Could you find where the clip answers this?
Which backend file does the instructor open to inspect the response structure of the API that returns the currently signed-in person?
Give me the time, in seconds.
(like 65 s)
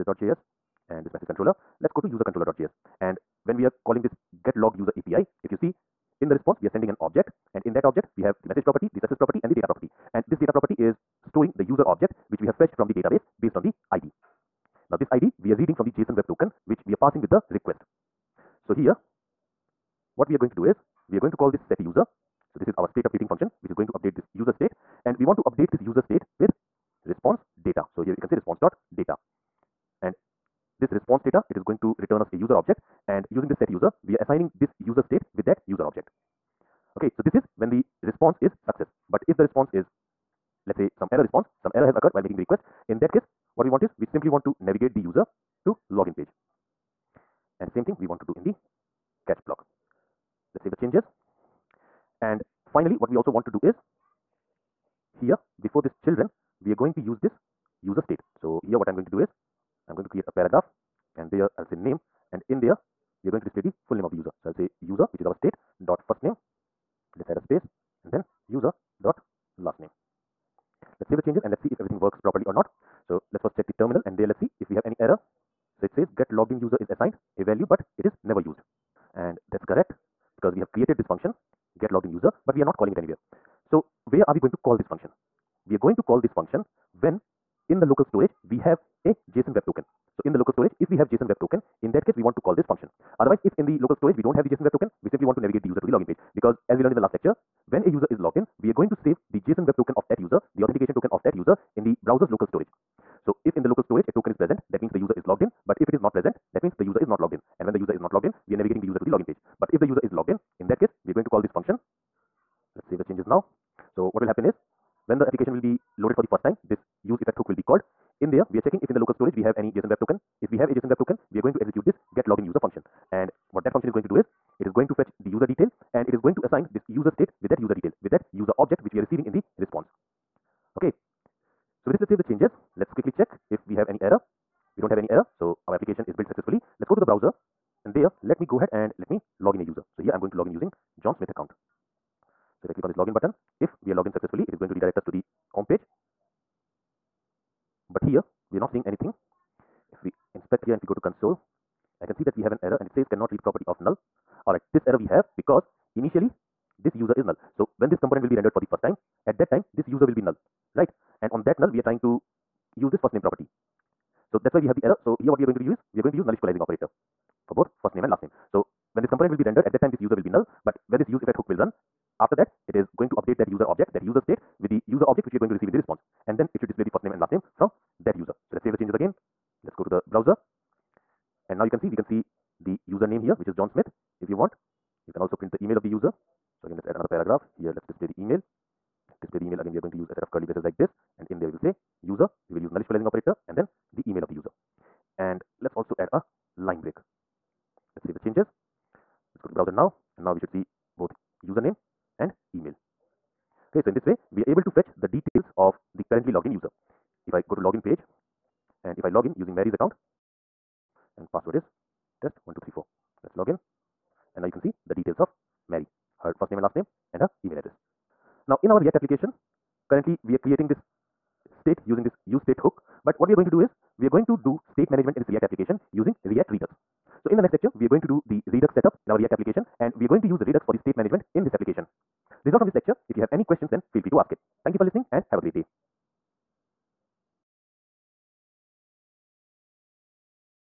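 2 s.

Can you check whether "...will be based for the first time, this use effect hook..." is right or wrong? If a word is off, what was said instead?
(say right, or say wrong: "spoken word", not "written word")
wrong: "loaded", not "based".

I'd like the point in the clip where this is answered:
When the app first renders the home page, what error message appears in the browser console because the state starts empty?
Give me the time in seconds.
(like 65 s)
153 s.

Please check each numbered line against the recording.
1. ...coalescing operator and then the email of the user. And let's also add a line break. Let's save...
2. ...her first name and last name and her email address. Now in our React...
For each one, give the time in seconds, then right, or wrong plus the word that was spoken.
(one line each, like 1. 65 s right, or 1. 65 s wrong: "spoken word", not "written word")
1. 192 s right
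2. 216 s right.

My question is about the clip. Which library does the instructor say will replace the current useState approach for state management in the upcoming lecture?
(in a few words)
React Redux.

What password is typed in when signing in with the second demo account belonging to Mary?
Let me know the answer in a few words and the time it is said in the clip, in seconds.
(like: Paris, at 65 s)
test1234, at 212 s.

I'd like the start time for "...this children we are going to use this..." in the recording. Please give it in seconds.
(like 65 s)
55 s.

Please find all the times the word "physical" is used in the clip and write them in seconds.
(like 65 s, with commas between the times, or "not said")
not said.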